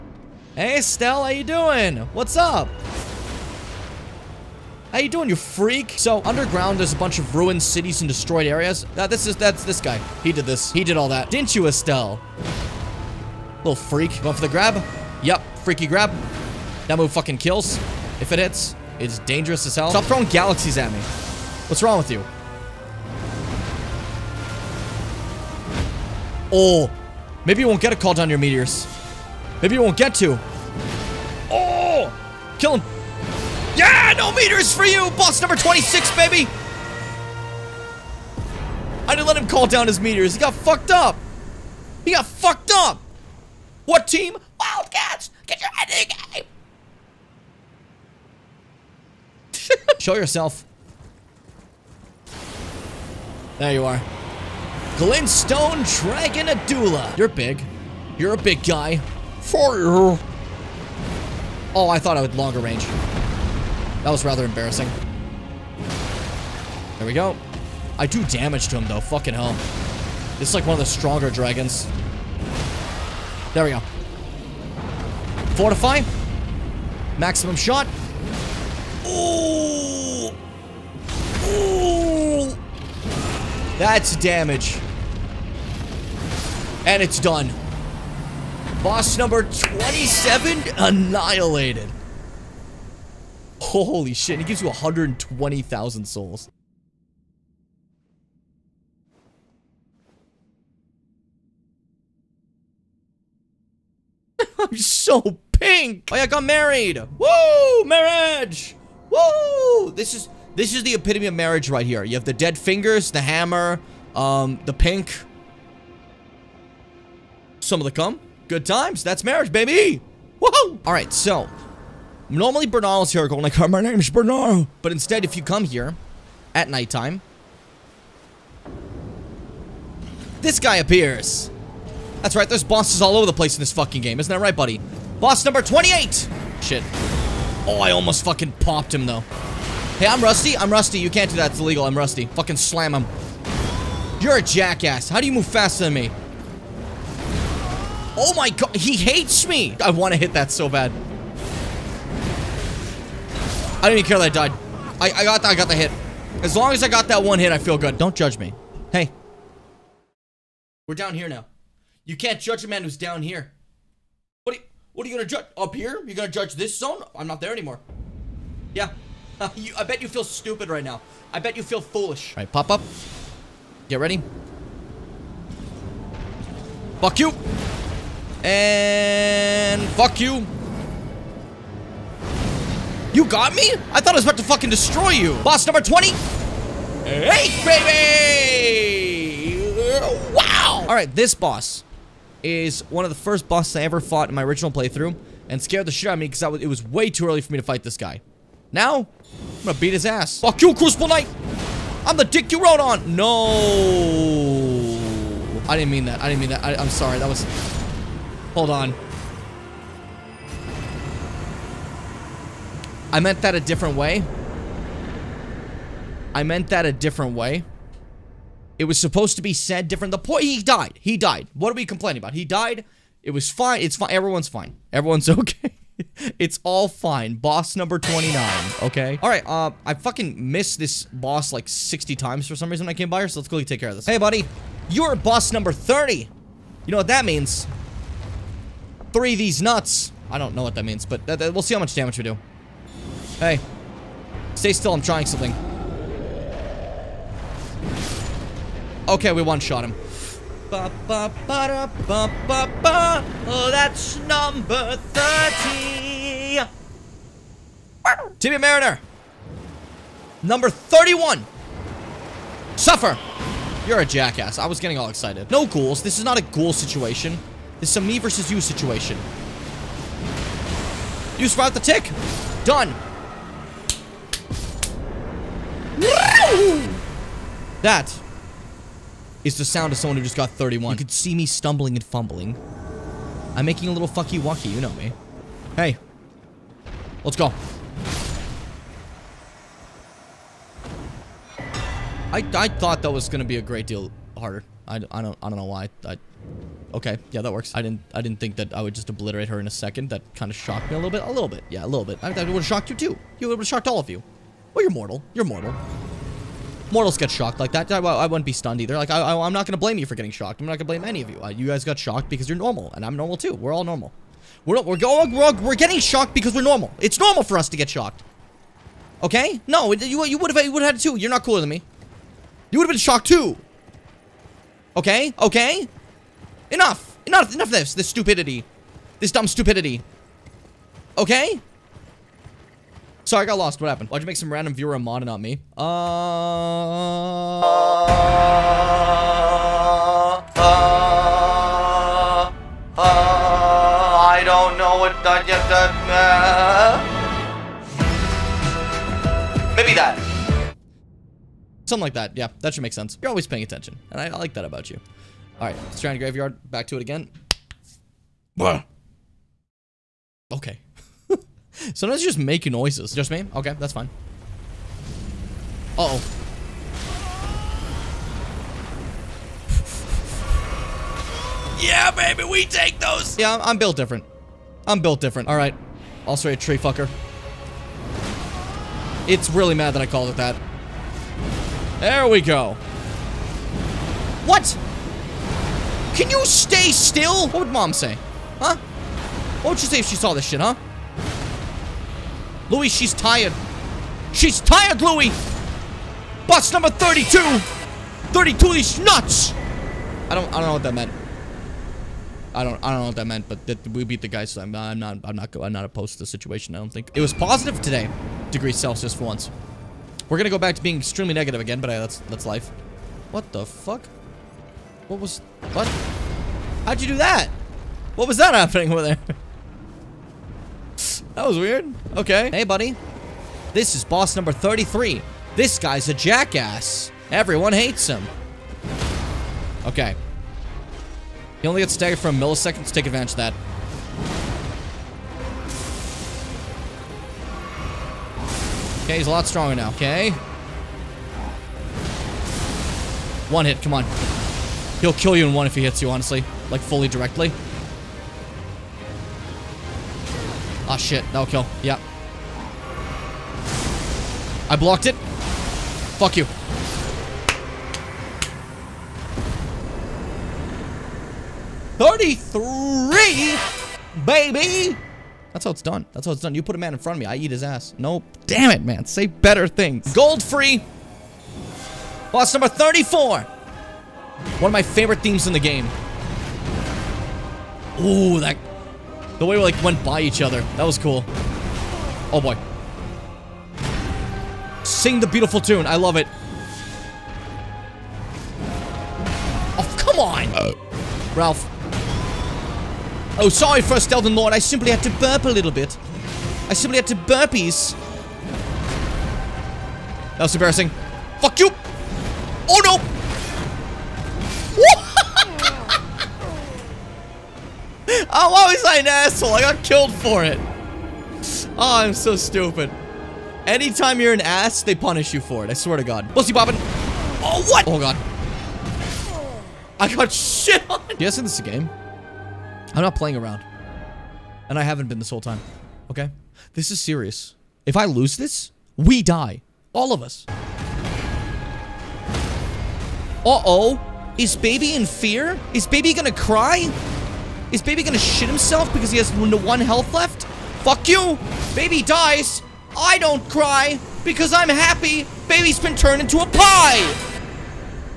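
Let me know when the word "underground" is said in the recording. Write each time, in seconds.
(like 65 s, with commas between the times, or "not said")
6 s.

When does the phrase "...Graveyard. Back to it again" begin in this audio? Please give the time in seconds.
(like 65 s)
356 s.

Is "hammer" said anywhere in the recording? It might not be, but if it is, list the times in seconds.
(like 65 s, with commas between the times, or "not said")
113 s.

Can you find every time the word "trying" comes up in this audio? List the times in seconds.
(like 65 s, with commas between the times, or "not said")
245 s.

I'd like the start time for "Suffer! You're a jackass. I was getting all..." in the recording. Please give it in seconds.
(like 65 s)
262 s.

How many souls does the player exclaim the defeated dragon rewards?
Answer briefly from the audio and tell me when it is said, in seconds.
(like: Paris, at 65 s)
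120,000, at 94 s.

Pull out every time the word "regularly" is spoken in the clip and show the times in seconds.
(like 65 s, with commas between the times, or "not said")
not said.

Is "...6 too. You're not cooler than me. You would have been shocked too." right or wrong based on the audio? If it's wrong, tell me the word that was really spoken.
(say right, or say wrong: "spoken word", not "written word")
wrong: "2", not "6".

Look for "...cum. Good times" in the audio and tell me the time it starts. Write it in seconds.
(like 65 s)
117 s.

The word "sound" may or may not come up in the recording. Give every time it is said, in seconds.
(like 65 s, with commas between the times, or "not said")
279 s.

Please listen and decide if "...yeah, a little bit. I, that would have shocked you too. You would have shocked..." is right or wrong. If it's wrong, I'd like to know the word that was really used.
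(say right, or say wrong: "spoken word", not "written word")
right.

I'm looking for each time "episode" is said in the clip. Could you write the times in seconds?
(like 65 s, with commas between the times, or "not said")
not said.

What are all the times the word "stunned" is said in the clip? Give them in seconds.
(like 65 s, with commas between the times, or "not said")
308 s.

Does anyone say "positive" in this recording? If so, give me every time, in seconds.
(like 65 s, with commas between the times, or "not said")
407 s.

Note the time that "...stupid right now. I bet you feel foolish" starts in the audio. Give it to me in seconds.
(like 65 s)
170 s.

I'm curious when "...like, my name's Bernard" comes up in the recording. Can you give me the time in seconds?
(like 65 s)
123 s.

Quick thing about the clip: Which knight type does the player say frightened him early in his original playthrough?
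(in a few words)
Crucible Knight.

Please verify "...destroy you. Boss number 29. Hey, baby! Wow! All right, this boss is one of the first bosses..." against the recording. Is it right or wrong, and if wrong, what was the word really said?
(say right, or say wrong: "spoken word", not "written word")
wrong: "20", not "29".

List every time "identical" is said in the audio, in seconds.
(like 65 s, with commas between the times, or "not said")
not said.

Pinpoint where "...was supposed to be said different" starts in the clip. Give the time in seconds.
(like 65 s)
218 s.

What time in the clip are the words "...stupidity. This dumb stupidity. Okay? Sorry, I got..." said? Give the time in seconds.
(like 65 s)
328 s.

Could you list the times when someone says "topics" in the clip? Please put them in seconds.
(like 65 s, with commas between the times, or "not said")
not said.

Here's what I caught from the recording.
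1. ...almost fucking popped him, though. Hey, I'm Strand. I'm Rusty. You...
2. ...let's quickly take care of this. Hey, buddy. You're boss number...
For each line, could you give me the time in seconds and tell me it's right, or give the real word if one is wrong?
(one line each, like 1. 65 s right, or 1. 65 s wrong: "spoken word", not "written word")
1. 137 s wrong: "Rusty", not "Strand"
2. 233 s right.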